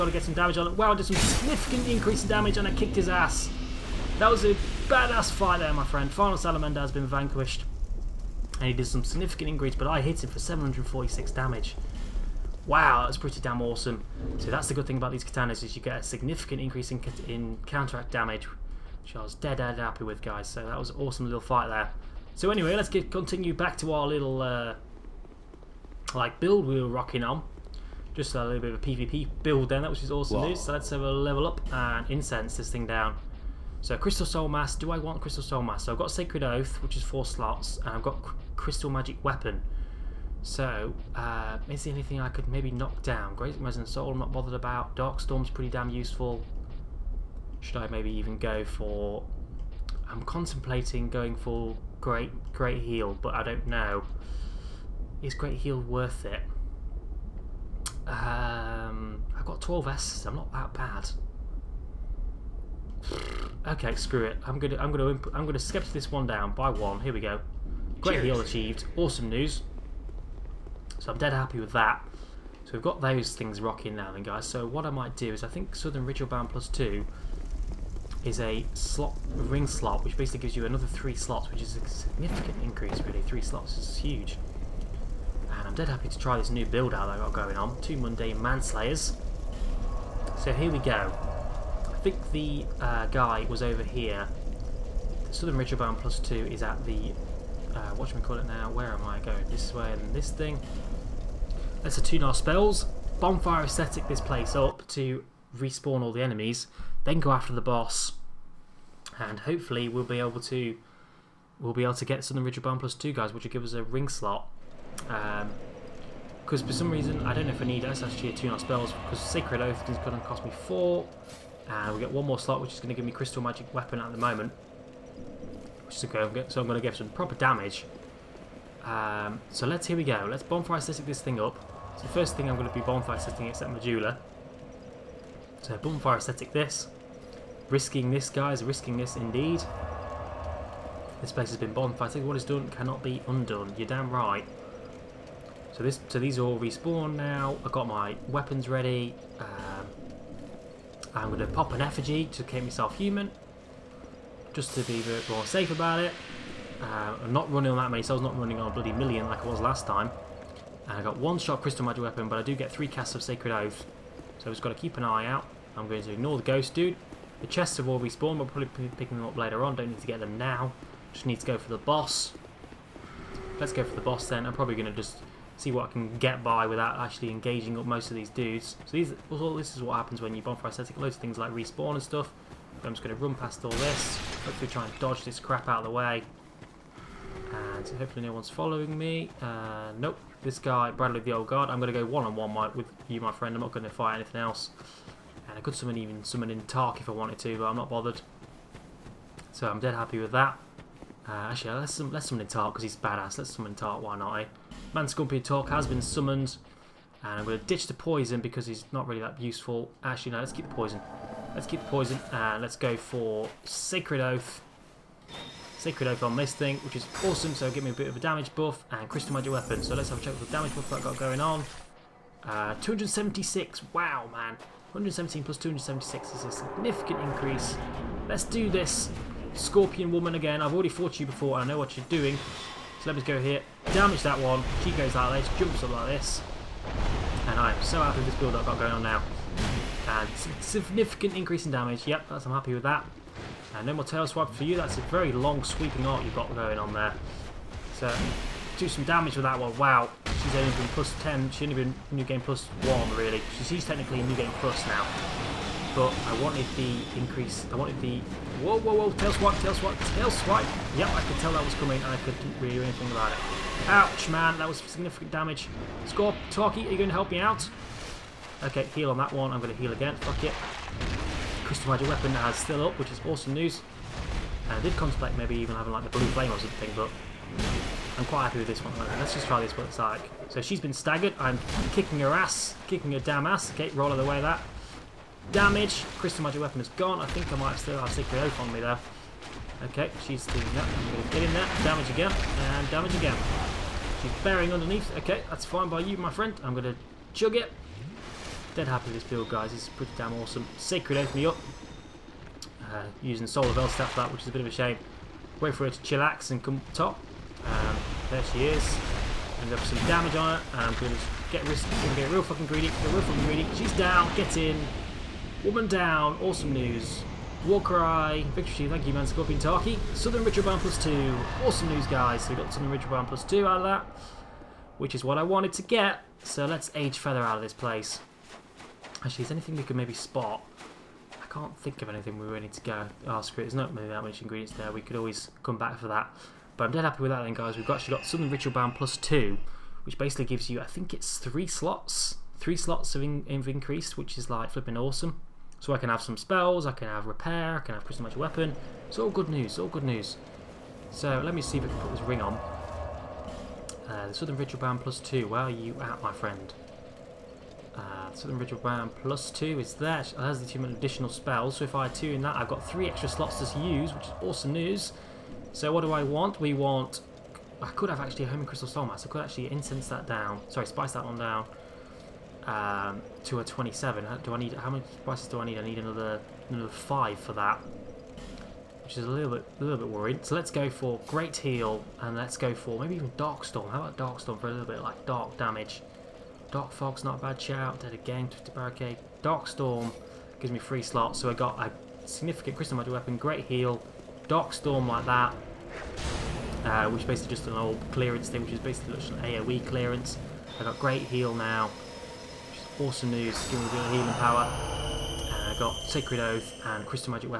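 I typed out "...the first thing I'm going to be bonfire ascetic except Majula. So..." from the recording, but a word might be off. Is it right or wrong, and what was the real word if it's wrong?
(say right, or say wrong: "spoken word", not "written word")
right.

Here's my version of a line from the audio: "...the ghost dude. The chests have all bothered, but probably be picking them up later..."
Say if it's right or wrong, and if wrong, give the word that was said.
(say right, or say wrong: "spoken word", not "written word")
wrong: "respawned", not "bothered".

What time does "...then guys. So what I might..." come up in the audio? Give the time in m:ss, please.
1:14.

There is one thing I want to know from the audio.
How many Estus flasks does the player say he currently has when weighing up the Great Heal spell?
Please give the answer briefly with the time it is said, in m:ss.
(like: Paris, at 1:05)
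12, at 0:59.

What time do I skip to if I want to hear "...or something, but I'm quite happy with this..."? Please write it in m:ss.
4:36.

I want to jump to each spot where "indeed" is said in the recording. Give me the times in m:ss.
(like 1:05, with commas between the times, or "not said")
2:19.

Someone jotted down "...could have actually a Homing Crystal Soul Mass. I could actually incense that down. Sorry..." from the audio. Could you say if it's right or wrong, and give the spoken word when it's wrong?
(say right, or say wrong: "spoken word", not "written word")
right.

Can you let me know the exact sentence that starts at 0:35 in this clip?
So I've got Sacred Oath, which is four slots, and I've got Crystal Magic Weapon.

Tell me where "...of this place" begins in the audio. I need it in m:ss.
5:27.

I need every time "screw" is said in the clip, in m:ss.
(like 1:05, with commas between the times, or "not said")
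1:03, 5:33.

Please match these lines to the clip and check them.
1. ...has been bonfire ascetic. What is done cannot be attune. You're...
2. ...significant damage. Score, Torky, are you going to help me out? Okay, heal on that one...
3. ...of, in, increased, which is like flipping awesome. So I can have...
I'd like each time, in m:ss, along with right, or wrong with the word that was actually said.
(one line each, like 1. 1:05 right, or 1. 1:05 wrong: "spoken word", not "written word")
1. 2:21 wrong: "undone", not "attune"
2. 4:24 right
3. 5:43 right.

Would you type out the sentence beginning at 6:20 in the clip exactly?
So let's go for Great Heal, and let's go for maybe even Dark Storm.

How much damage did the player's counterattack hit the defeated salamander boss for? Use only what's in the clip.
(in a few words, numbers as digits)
746.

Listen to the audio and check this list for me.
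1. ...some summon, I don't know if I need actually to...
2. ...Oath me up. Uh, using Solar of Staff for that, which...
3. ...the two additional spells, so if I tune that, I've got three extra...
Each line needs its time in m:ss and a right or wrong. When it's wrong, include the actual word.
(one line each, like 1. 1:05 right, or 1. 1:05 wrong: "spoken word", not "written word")
1. 1:56 wrong: "reason", not "summon"
2. 5:01 right
3. 6:00 right.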